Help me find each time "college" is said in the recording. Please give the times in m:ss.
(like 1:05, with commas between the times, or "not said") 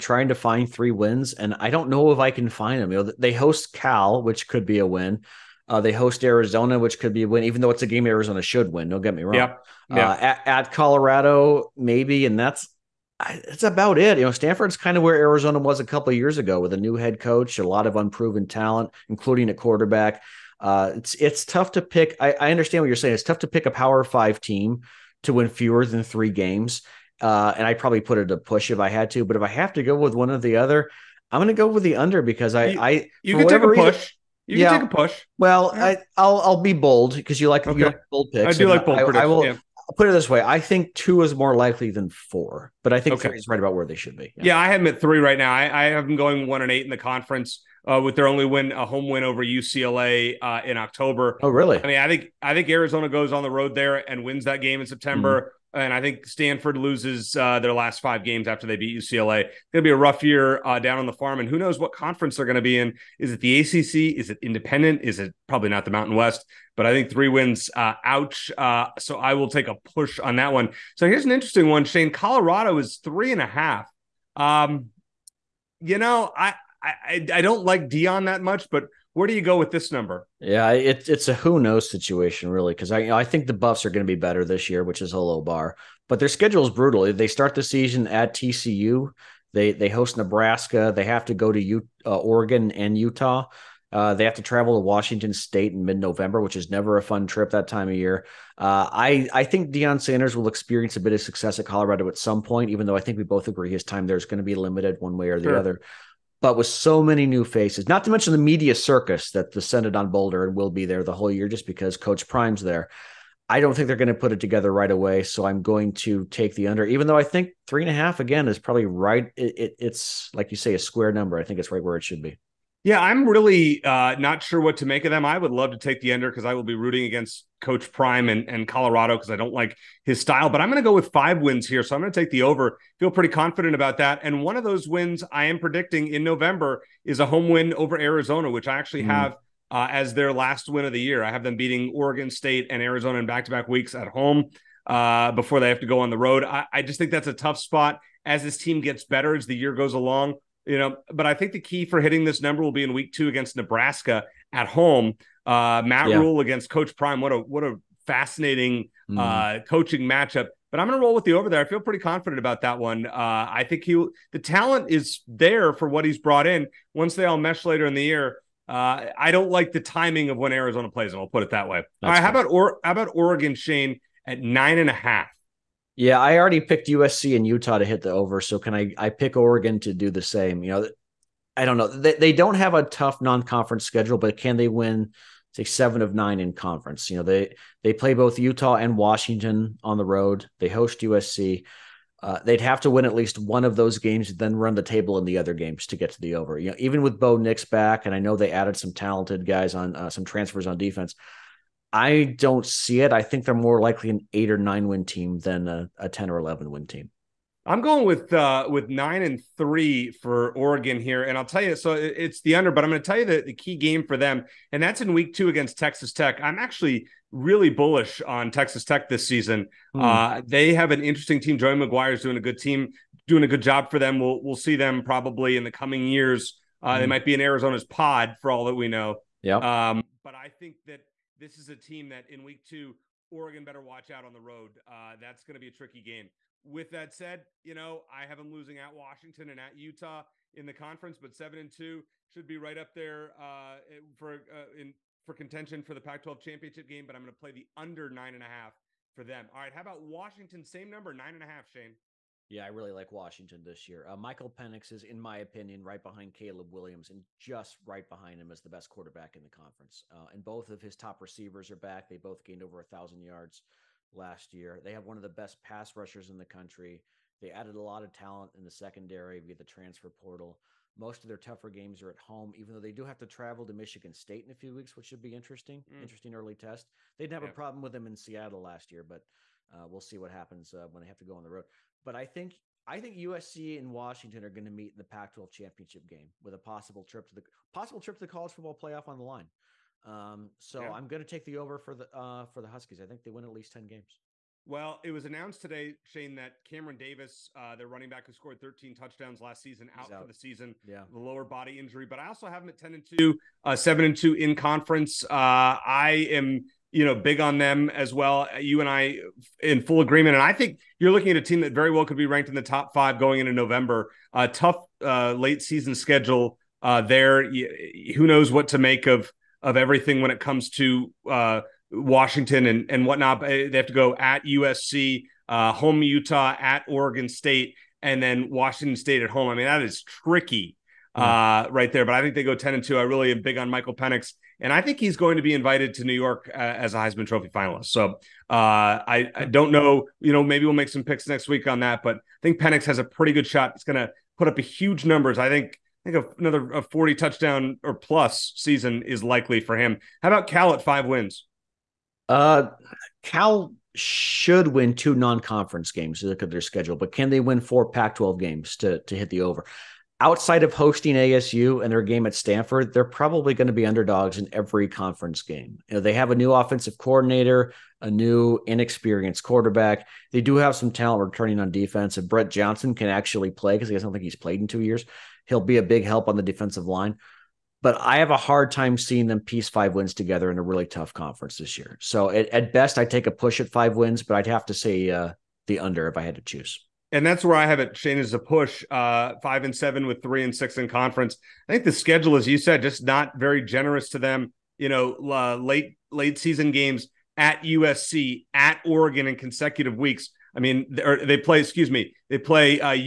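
4:48.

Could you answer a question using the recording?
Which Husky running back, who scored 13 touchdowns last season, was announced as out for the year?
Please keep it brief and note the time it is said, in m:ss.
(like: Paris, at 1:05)
Cameron Davis, at 4:56.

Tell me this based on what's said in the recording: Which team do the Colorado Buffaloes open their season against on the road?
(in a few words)
TCU.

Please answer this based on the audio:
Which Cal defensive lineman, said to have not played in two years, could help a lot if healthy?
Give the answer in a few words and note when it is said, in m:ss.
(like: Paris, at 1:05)
Brett Johnson, at 6:12.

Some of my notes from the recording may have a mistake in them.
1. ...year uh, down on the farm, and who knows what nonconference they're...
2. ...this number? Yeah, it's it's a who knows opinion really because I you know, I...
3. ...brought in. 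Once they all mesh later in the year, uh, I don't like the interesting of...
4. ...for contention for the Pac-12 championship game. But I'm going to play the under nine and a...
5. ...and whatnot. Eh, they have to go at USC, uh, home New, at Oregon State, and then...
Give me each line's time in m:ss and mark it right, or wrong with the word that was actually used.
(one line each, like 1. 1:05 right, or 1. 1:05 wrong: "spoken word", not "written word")
1. 1:00 wrong: "conference", not "nonconference"
2. 1:19 wrong: "situation", not "opinion"
3. 2:46 wrong: "timing", not "interesting"
4. 4:05 right
5. 5:22 wrong: "Utah", not "New".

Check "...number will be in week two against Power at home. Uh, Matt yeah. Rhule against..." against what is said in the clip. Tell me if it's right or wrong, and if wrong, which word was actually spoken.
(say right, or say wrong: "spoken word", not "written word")
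wrong: "Nebraska", not "Power".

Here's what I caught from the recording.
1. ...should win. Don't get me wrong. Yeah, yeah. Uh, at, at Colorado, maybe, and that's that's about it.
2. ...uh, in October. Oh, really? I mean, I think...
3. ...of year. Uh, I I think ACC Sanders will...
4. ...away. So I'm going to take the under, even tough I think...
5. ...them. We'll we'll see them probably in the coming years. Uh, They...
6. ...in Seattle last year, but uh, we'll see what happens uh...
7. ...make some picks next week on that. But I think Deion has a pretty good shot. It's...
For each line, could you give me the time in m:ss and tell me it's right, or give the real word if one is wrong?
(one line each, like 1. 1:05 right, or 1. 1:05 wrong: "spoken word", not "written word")
1. 0:08 right
2. 0:50 right
3. 1:37 wrong: "Deion", not "ACC"
4. 1:54 wrong: "though", not "tough"
5. 3:43 right
6. 4:38 right
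7. 5:40 wrong: "Penix", not "Deion".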